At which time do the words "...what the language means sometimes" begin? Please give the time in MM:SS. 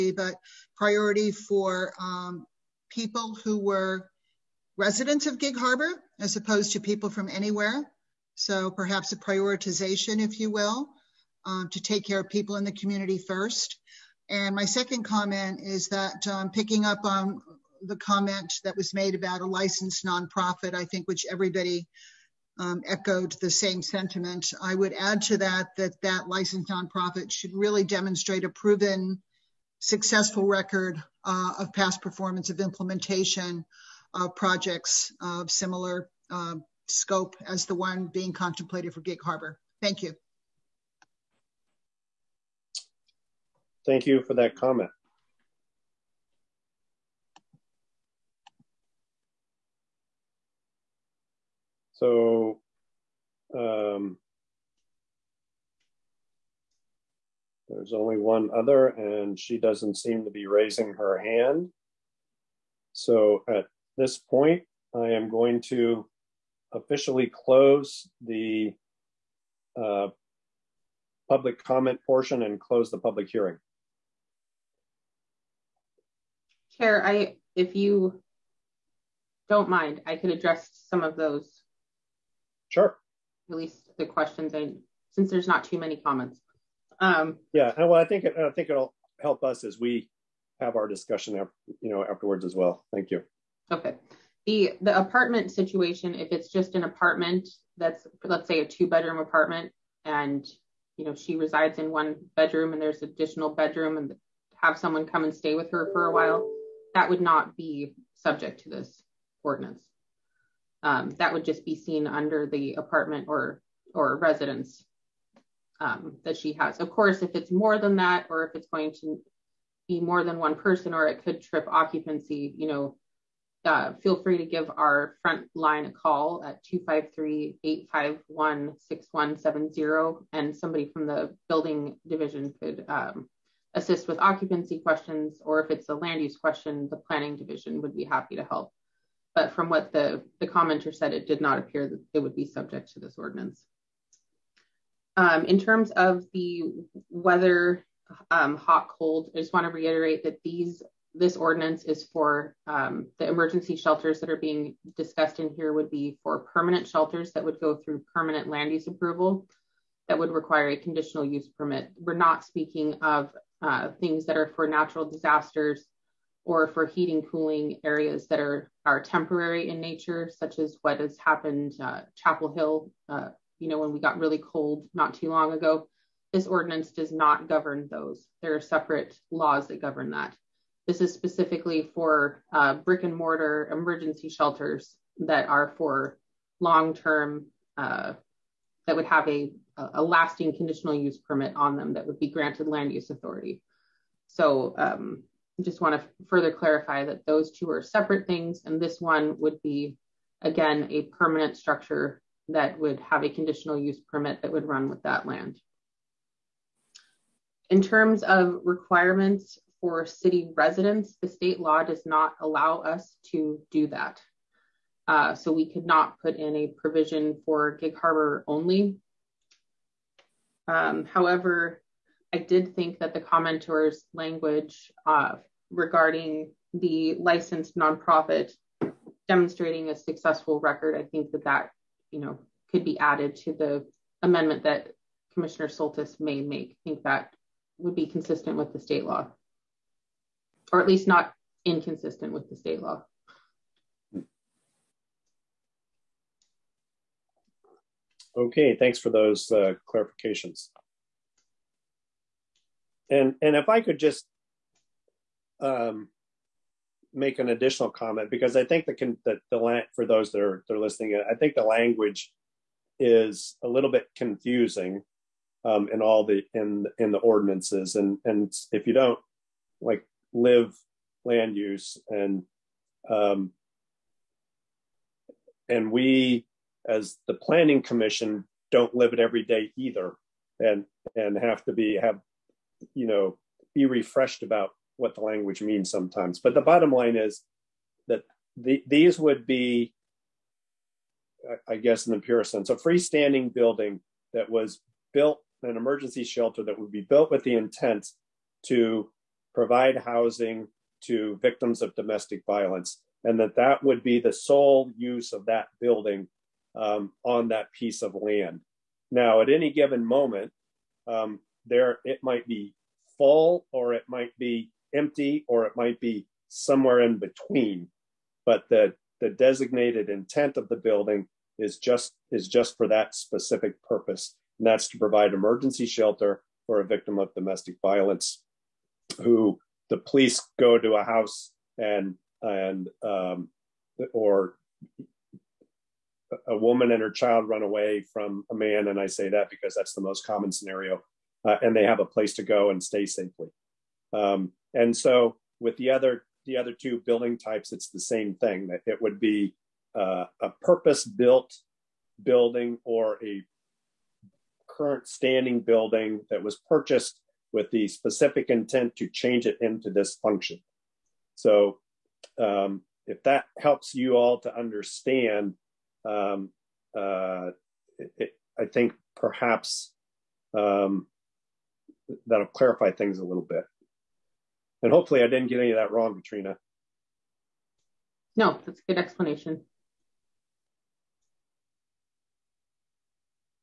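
04:44.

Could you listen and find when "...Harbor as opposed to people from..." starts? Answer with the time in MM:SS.
00:05.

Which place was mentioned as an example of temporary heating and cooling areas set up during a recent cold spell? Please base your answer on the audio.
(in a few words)
Chapel Hill.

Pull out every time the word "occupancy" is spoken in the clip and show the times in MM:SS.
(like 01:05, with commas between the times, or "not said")
02:01, 02:14.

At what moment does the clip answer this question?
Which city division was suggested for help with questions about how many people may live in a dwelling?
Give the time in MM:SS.
02:11.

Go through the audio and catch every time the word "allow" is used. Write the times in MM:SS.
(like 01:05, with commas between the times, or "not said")
03:32.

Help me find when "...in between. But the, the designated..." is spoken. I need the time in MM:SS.
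05:17.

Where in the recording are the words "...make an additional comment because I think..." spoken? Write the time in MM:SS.
04:17.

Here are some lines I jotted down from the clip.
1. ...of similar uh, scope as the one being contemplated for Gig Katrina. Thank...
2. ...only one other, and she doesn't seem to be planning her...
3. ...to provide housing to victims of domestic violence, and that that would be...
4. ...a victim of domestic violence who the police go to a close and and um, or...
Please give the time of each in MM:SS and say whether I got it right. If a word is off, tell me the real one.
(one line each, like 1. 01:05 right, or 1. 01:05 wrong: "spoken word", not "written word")
1. 00:35 wrong: "Harbor", not "Katrina"
2. 00:57 wrong: "raising", not "planning"
3. 04:58 right
4. 05:26 wrong: "house", not "close".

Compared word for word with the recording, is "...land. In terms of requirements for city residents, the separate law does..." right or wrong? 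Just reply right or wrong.
wrong.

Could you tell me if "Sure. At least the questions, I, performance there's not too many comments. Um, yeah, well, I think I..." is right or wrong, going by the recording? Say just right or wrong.
wrong.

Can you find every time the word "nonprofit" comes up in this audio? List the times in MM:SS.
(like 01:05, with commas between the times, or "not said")
00:20, 00:26, 03:47.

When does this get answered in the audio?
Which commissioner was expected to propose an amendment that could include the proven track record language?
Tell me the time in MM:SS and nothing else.
03:55.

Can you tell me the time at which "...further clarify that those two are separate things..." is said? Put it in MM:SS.
03:16.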